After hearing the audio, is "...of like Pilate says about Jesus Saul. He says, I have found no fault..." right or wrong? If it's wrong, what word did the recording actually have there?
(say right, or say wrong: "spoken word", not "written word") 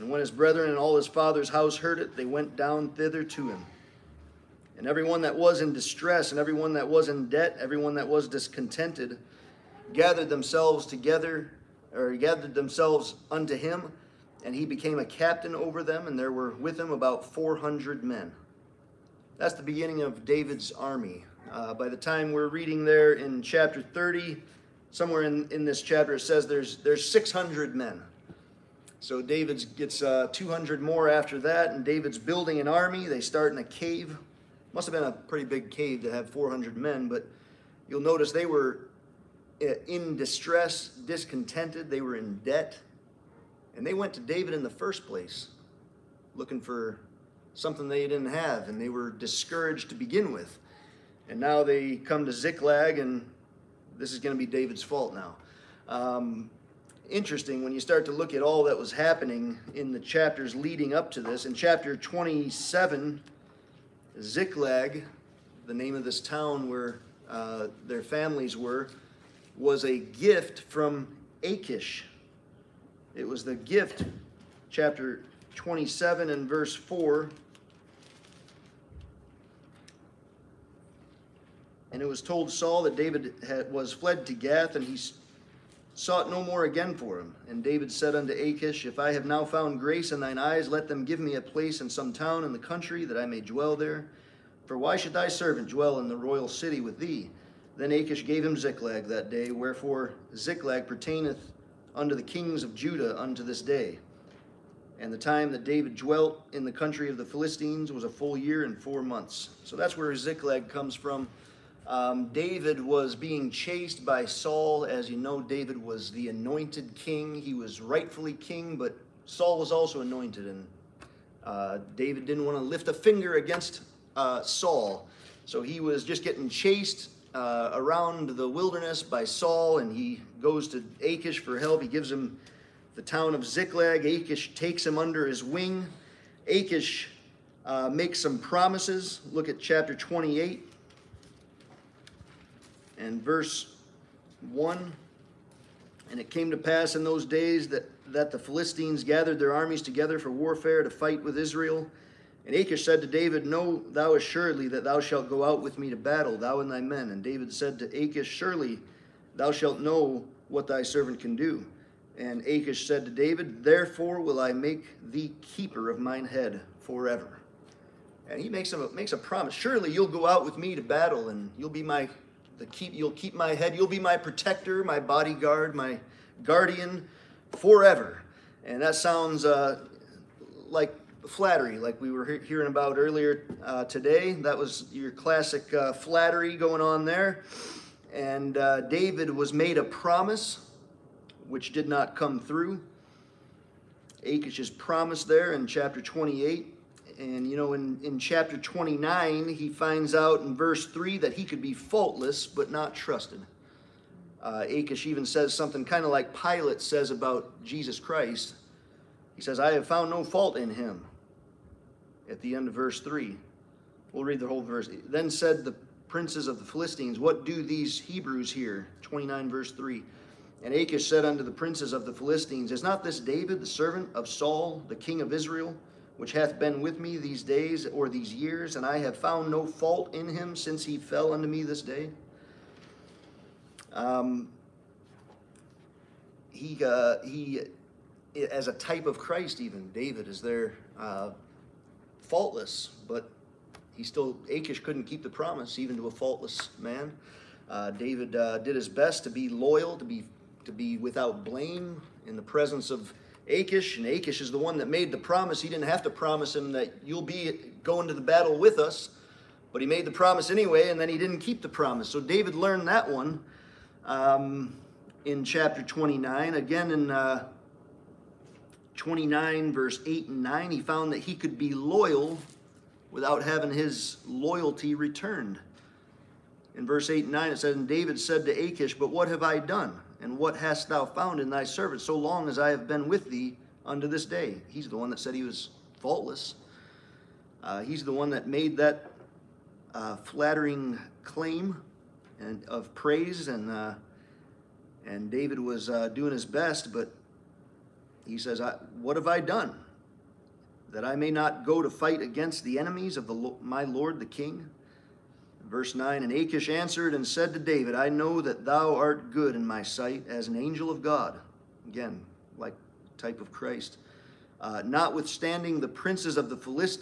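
wrong: "Christ", not "Saul".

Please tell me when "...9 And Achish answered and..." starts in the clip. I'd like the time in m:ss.
5:05.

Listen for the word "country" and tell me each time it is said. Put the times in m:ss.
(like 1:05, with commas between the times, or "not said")
1:32, 1:46.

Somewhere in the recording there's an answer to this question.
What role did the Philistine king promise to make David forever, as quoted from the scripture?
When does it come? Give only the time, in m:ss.
2:45.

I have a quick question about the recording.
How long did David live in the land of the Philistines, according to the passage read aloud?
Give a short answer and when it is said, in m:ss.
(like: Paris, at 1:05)
A full year and four months, at 1:48.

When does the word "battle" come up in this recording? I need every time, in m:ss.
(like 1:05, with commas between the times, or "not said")
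2:35, 2:50, 4:18.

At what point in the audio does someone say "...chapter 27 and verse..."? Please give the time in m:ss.
1:14.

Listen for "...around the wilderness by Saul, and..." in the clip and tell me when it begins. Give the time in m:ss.
2:07.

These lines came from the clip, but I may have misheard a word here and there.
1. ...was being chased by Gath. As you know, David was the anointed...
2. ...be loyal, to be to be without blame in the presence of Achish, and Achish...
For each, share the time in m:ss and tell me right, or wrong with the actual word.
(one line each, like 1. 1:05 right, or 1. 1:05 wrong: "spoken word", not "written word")
1. 1:52 wrong: "Saul", not "Gath"
2. 4:09 right.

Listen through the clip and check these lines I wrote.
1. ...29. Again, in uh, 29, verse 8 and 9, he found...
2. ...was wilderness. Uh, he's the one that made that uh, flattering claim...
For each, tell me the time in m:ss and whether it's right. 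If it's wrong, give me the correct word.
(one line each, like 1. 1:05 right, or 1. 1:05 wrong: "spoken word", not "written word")
1. 4:25 right
2. 4:45 wrong: "faultless", not "wilderness".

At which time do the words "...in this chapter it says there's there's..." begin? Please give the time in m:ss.
0:25.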